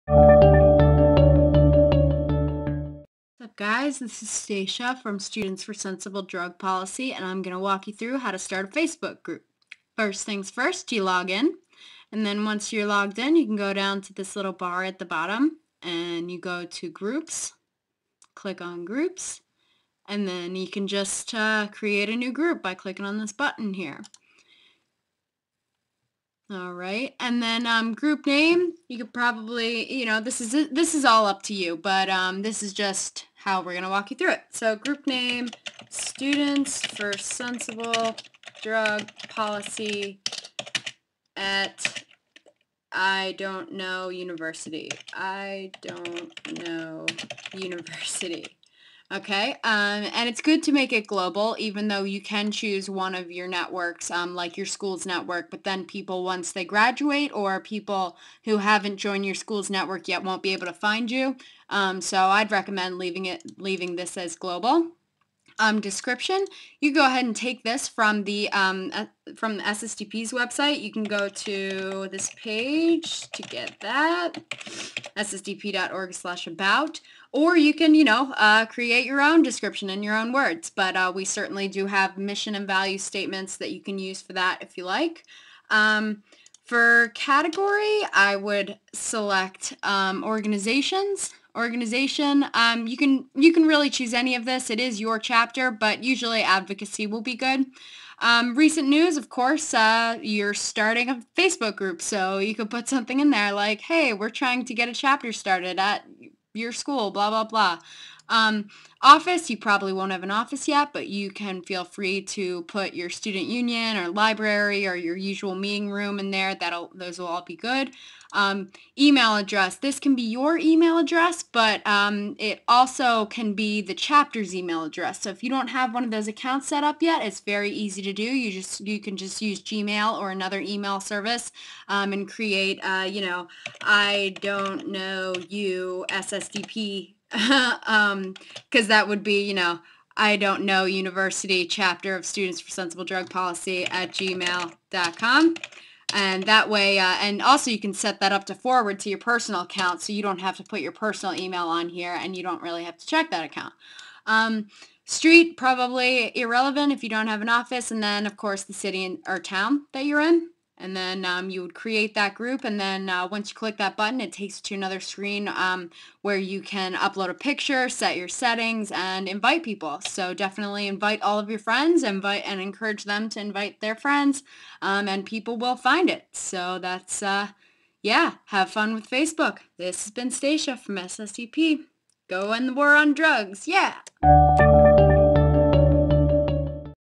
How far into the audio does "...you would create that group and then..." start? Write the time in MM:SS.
02:41.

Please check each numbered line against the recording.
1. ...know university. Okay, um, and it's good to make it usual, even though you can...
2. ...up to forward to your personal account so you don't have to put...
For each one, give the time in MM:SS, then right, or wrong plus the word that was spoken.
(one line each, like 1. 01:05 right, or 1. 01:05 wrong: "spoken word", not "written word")
1. 00:46 wrong: "global", not "usual"
2. 02:28 right.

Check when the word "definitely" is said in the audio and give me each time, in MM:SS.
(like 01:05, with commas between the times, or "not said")
02:50.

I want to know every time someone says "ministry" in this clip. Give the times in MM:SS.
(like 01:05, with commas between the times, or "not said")
not said.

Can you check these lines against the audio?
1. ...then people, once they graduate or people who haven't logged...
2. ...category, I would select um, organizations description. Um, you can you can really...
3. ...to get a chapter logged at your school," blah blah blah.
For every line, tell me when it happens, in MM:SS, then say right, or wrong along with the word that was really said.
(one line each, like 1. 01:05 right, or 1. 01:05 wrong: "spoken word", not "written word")
1. 00:55 wrong: "joined", not "logged"
2. 01:27 wrong: "organization", not "description"
3. 01:44 wrong: "started", not "logged".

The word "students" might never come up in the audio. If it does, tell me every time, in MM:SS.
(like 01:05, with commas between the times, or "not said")
00:05, 00:35, 01:53, 02:22.